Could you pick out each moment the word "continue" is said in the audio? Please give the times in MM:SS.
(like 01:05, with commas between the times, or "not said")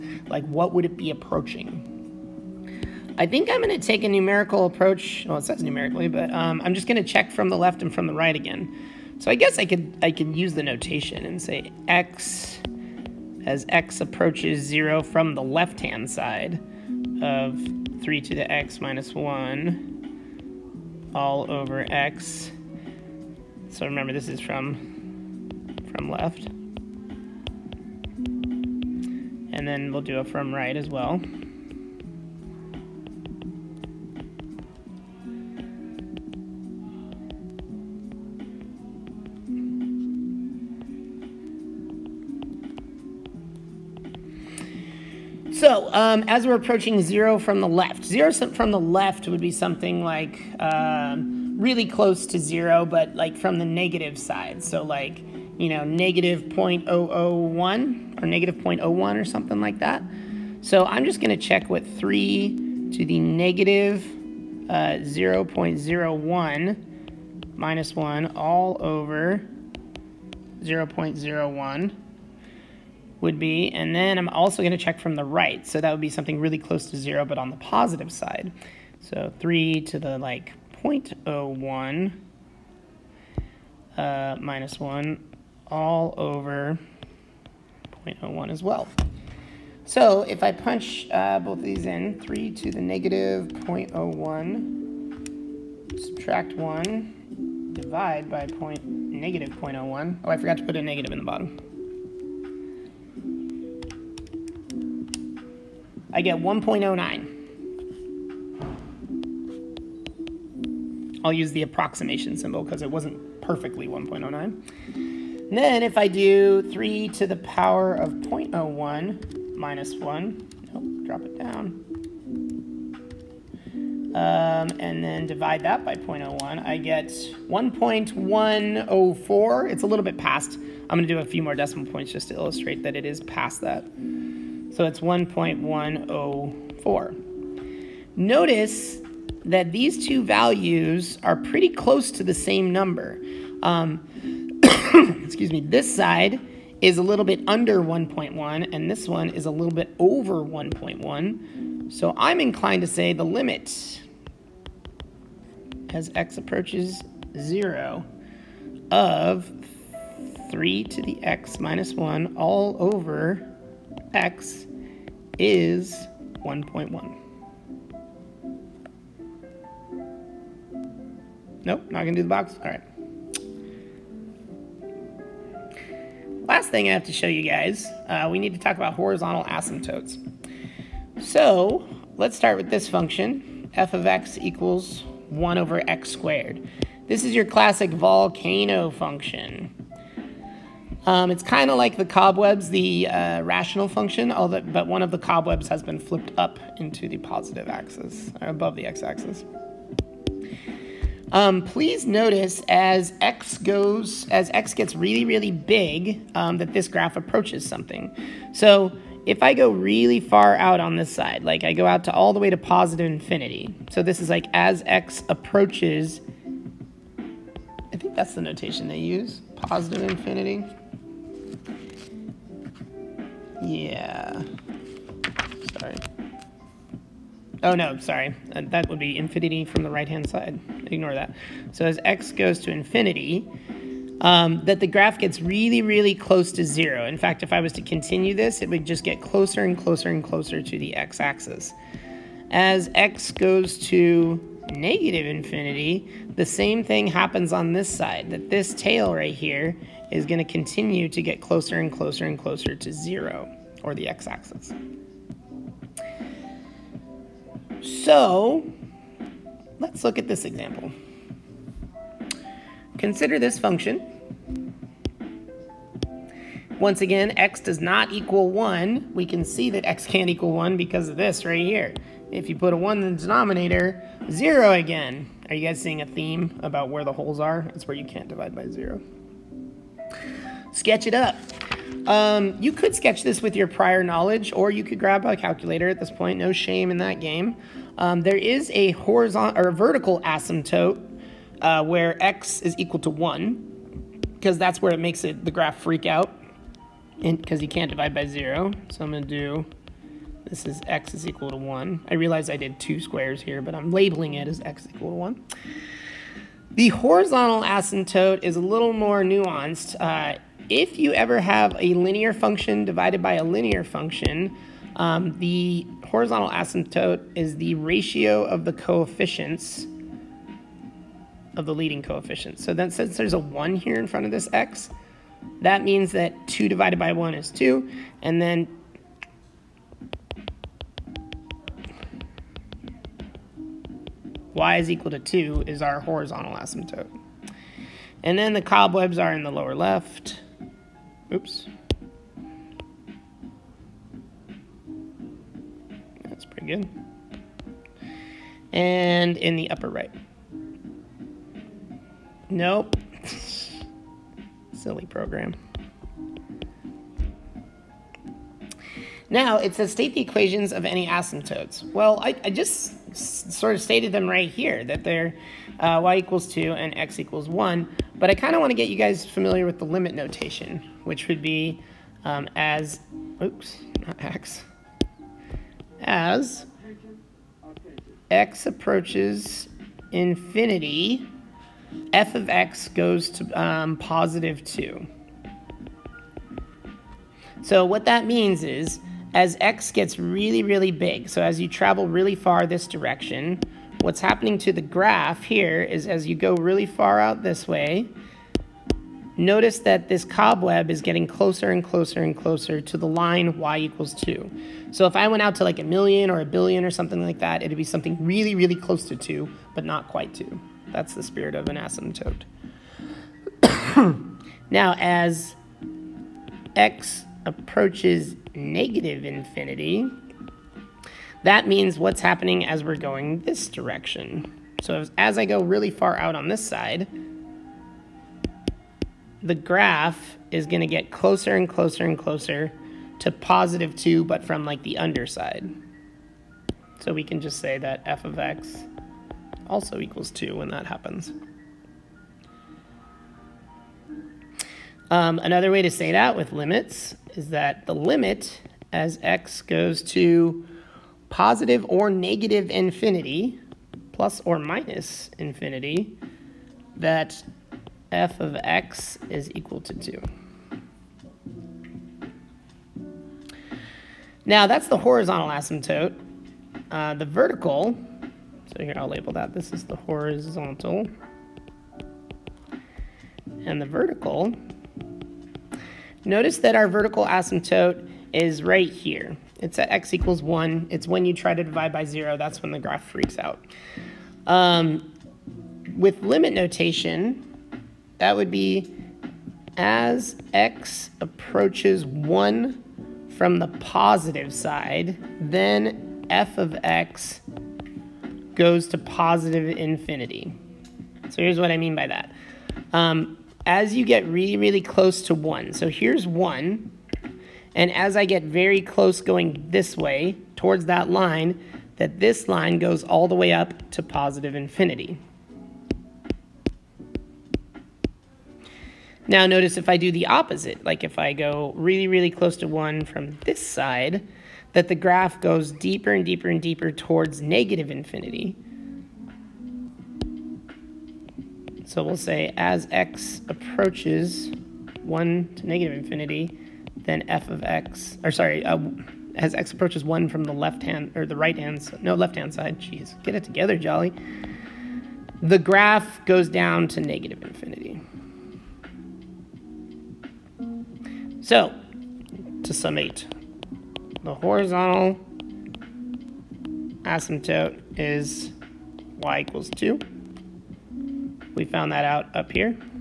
03:57, 04:10.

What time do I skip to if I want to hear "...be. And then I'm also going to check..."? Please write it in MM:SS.
01:13.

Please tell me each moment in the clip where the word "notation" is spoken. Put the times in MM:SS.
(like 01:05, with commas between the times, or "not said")
00:10, 03:38, 06:10, 08:06.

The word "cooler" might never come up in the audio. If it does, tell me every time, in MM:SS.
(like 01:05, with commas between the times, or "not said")
not said.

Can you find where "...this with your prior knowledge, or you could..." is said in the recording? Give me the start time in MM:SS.
04:43.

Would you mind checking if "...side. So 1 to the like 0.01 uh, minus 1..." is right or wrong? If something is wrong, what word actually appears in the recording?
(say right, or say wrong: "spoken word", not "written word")
wrong: "3", not "1".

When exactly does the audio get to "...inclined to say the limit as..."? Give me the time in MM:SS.
02:32.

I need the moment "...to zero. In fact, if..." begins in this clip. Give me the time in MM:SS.
03:56.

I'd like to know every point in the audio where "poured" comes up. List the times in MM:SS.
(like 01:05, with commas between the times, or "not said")
not said.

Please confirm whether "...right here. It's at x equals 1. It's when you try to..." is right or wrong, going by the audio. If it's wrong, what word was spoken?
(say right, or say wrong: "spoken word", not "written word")
right.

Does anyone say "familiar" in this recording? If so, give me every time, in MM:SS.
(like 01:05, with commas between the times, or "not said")
06:09.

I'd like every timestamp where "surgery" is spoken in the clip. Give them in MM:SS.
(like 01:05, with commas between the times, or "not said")
not said.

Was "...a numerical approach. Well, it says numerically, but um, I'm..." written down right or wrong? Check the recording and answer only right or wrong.
right.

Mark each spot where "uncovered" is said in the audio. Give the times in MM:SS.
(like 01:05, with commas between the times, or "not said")
not said.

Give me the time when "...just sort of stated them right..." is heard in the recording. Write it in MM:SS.
06:02.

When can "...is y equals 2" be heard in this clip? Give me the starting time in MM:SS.
09:17.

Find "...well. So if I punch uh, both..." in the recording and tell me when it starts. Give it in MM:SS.
01:28.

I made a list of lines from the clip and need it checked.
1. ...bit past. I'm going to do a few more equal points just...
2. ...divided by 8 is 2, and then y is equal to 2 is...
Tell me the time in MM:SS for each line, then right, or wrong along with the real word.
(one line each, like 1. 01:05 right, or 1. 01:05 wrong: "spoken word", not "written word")
1. 02:10 wrong: "decimal", not "equal"
2. 05:26 wrong: "1", not "8".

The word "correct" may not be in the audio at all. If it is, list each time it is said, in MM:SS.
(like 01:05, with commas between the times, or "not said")
not said.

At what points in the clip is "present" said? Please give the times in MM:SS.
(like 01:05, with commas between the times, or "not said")
not said.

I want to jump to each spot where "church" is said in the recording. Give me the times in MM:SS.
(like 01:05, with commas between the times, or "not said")
not said.